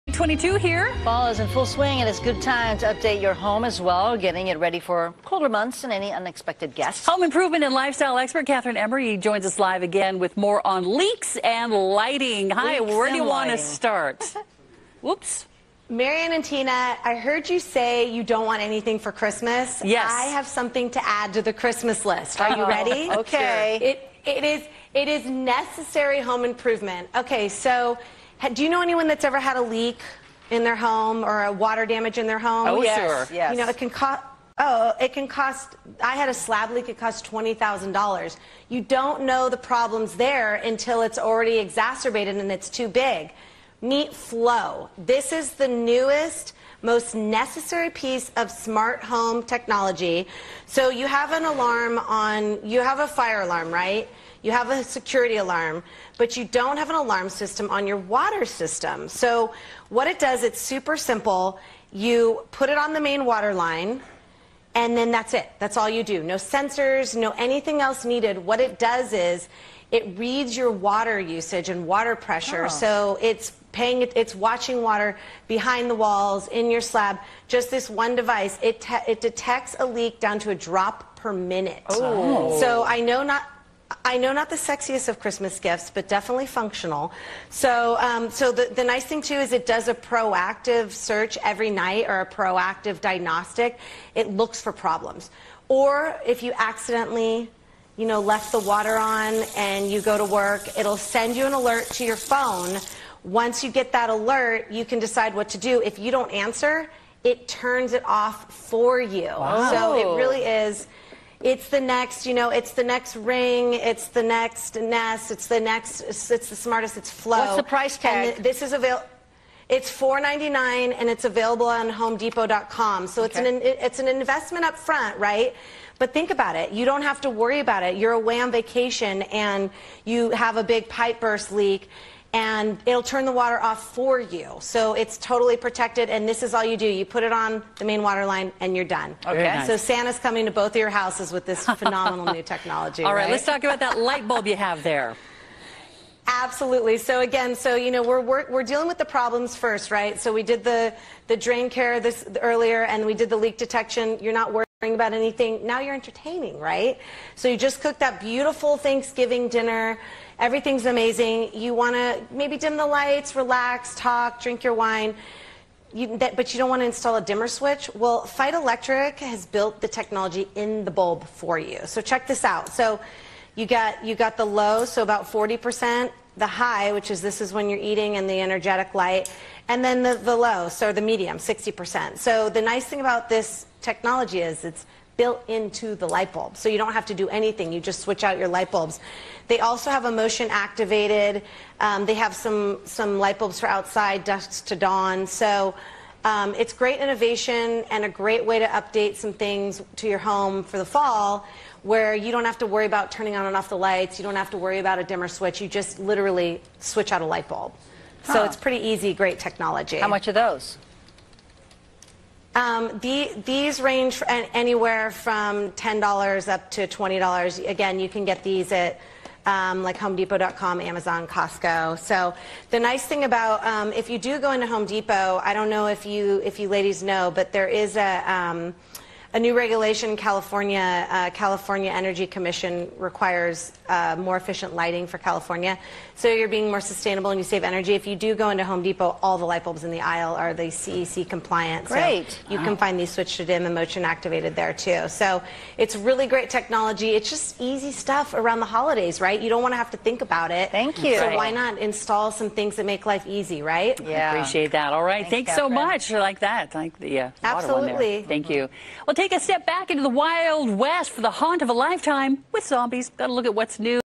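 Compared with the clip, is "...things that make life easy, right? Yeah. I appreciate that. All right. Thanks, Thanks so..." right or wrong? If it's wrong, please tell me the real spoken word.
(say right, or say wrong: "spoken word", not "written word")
right.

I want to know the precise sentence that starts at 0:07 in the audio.
Home improvement and lifestyle expert Kathryn Emery joins us live again with more on leaks and lighting.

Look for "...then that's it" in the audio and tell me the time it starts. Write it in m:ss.
1:04.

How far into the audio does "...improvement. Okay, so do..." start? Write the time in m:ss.
0:26.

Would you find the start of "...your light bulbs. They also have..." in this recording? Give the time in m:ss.
3:08.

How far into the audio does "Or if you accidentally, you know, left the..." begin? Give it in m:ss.
1:35.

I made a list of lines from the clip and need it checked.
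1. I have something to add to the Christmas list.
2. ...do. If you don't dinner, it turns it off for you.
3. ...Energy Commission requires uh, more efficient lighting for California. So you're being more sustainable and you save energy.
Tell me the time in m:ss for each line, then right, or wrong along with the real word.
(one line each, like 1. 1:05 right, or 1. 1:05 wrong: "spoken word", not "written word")
1. 0:20 right
2. 1:45 wrong: "answer", not "dinner"
3. 3:51 right.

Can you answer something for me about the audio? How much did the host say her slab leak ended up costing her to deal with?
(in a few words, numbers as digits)
$20,000.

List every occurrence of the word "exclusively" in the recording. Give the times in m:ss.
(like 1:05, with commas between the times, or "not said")
not said.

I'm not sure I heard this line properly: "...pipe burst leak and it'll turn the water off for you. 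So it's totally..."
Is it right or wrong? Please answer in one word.
right.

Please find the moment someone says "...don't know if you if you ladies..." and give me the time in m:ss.
3:45.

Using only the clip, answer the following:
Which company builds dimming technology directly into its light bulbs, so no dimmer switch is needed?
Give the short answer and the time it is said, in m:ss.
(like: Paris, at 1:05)
Feit Electric, at 2:48.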